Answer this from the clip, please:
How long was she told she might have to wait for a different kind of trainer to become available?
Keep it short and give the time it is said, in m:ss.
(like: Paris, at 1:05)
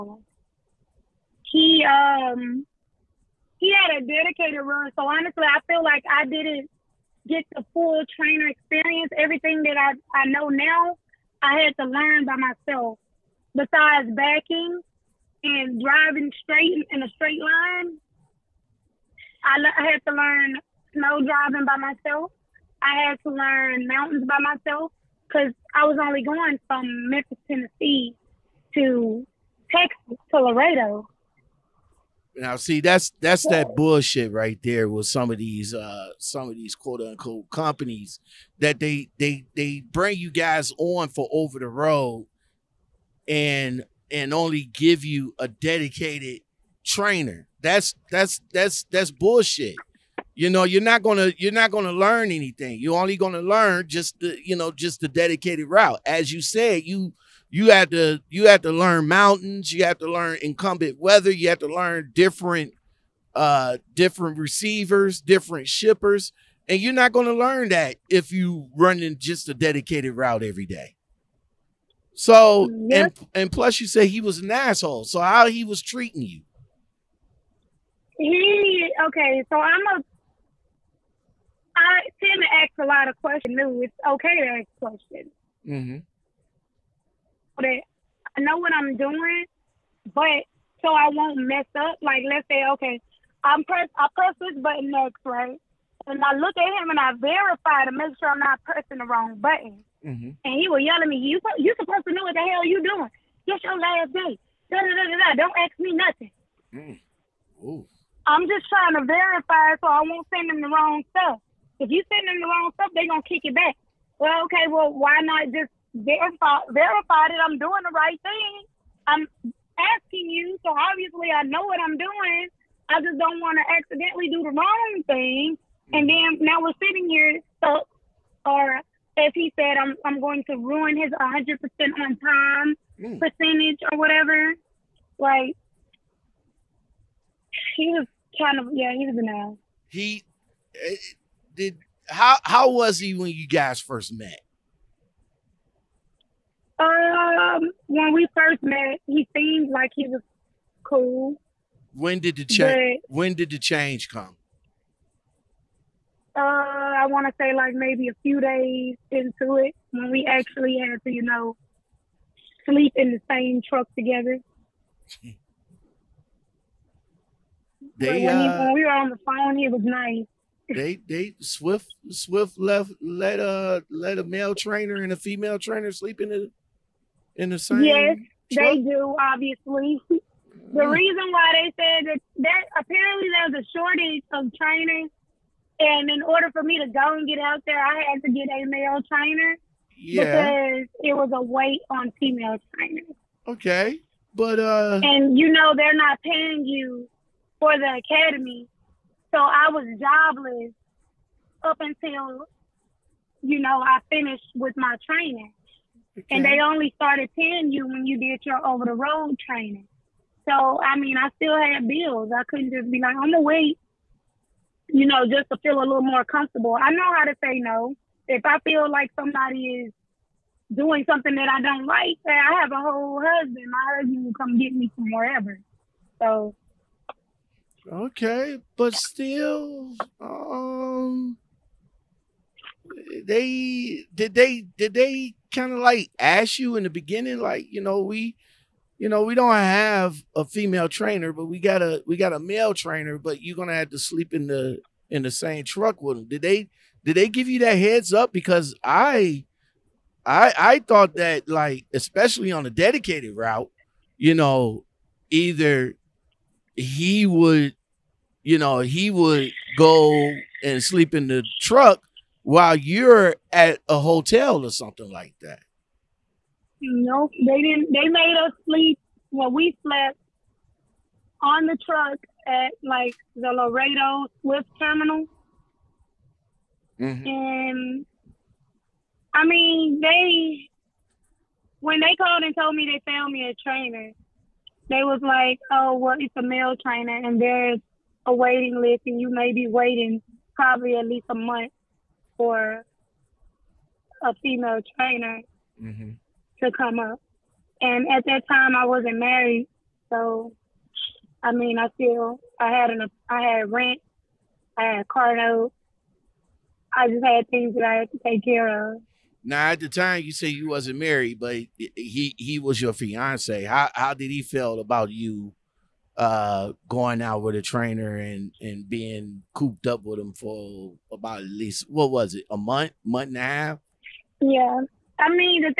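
at least a month, at 4:50.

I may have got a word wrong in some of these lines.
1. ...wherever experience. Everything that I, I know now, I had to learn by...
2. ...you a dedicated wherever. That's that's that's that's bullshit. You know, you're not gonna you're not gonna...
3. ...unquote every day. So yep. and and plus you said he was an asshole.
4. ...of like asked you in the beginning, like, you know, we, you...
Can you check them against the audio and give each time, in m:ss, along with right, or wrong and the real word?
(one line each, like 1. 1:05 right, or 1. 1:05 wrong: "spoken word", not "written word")
1. 0:08 wrong: "trainer", not "wherever"
2. 0:45 wrong: "trainer", not "wherever"
3. 1:10 wrong: "route", not "unquote"
4. 3:55 right.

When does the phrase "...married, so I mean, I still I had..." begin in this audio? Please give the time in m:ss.
4:59.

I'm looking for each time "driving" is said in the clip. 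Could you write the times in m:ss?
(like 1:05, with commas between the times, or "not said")
0:15, 0:21.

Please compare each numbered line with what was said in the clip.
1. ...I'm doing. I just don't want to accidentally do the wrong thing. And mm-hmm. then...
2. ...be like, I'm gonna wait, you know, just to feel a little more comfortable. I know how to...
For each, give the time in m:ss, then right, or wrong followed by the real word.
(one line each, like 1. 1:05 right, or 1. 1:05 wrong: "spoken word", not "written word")
1. 2:01 right
2. 3:32 right.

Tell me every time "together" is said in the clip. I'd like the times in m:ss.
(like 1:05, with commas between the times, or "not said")
2:43.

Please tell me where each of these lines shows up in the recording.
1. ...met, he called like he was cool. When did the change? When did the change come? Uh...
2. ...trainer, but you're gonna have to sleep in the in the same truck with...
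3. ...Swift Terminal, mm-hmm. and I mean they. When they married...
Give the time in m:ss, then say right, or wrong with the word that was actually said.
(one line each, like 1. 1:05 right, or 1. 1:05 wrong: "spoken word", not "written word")
1. 2:28 wrong: "seemed", not "called"
2. 4:02 right
3. 4:34 wrong: "called", not "married".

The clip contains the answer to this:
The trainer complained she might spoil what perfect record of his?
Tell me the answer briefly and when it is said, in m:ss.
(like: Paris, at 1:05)
100% on time, at 2:11.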